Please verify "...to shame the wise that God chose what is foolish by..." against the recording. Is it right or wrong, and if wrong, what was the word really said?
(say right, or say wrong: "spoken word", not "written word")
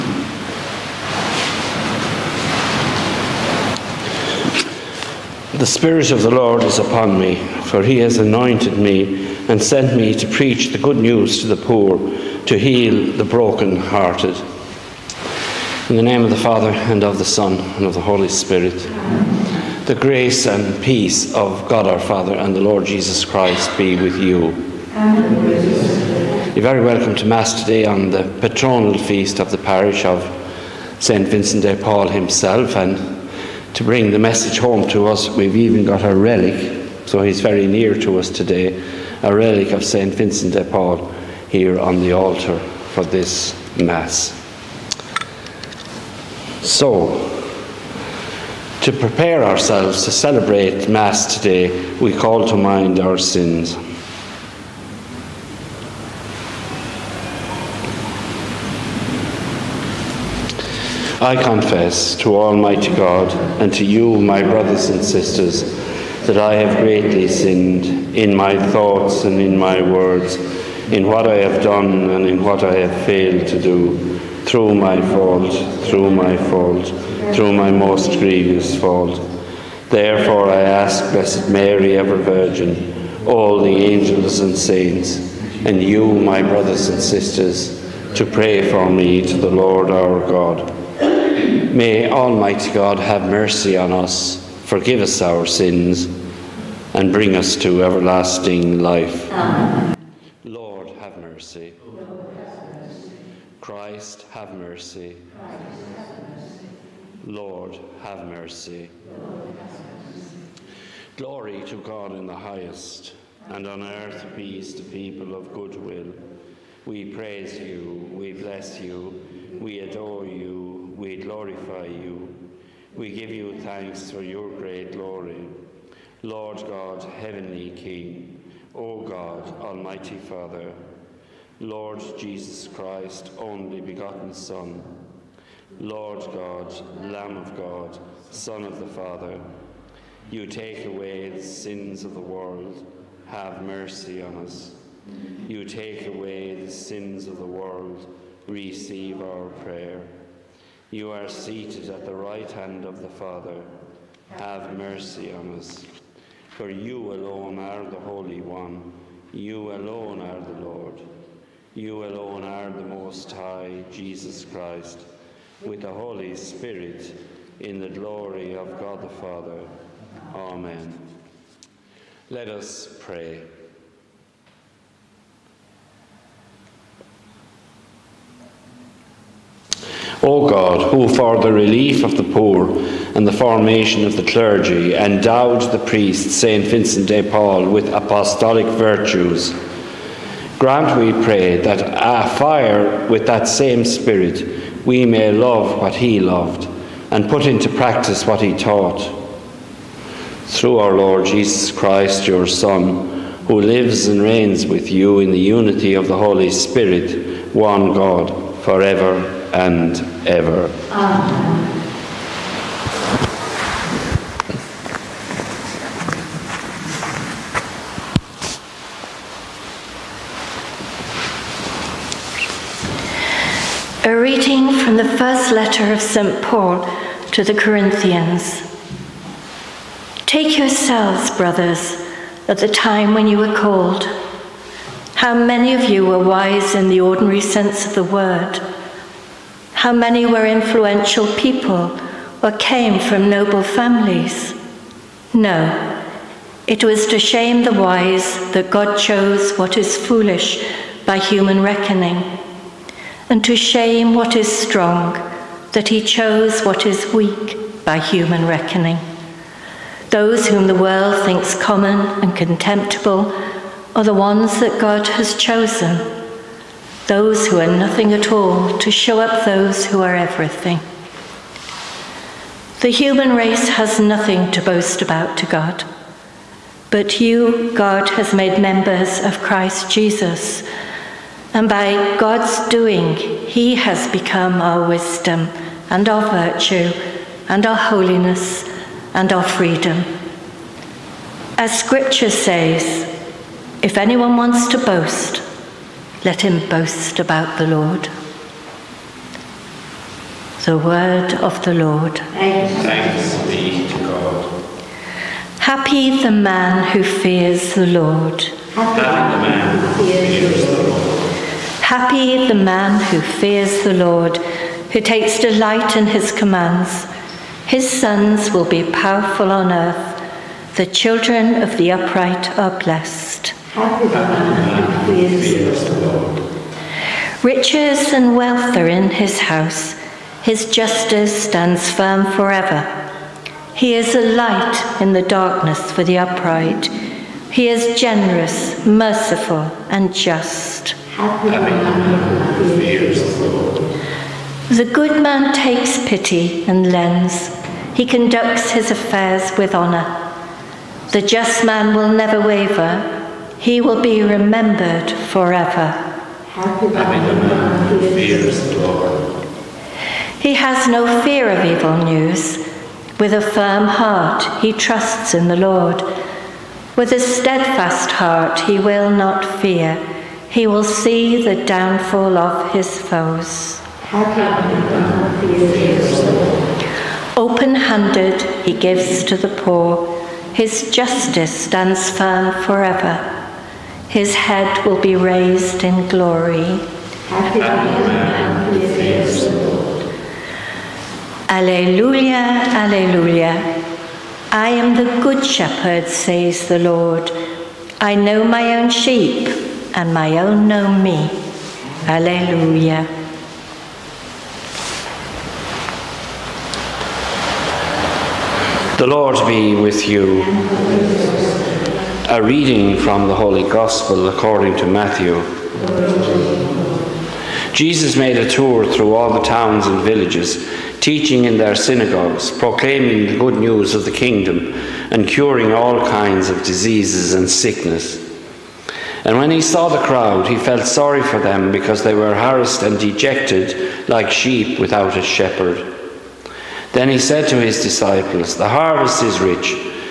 right.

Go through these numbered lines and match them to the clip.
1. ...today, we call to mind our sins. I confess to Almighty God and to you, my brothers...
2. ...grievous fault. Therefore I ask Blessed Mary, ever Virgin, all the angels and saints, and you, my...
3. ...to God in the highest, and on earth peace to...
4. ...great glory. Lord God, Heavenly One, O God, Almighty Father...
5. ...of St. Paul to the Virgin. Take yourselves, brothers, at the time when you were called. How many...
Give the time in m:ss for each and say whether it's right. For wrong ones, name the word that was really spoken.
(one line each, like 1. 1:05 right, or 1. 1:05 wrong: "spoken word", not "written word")
1. 0:51 right
2. 1:18 right
3. 1:51 right
4. 2:04 wrong: "King", not "One"
5. 3:45 wrong: "Corinthians", not "Virgin".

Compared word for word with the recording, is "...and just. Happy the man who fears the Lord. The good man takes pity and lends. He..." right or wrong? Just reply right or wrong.
right.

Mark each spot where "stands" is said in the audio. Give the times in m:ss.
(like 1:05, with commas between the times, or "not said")
5:31, 6:21.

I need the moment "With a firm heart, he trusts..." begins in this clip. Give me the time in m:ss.
6:03.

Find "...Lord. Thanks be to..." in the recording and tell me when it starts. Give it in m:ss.
5:01.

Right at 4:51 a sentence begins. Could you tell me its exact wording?
As Scripture says, if anyone wants to boast, let him boast about the Lord.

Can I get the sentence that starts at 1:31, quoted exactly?
May Almighty God have mercy on us, forgive us our sins, and bring us to everlasting life.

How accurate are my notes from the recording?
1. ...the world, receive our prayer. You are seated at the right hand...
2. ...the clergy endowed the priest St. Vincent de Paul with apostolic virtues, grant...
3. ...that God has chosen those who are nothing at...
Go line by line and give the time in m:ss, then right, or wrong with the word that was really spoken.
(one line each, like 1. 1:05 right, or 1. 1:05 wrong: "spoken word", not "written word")
1. 2:27 right
2. 3:04 right
3. 4:24 right.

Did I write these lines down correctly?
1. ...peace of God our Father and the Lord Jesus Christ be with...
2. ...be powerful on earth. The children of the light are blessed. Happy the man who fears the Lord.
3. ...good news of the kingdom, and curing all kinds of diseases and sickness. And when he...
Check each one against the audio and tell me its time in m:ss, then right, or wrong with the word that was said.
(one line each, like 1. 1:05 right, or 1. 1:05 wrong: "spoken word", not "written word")
1. 0:20 right
2. 5:18 wrong: "upright", not "light"
3. 7:03 right.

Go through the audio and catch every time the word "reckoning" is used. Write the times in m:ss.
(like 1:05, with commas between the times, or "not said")
4:11, 4:18.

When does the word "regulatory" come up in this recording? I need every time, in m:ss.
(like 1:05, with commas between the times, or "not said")
not said.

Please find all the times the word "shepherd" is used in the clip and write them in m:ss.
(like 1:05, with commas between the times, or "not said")
6:35, 7:15.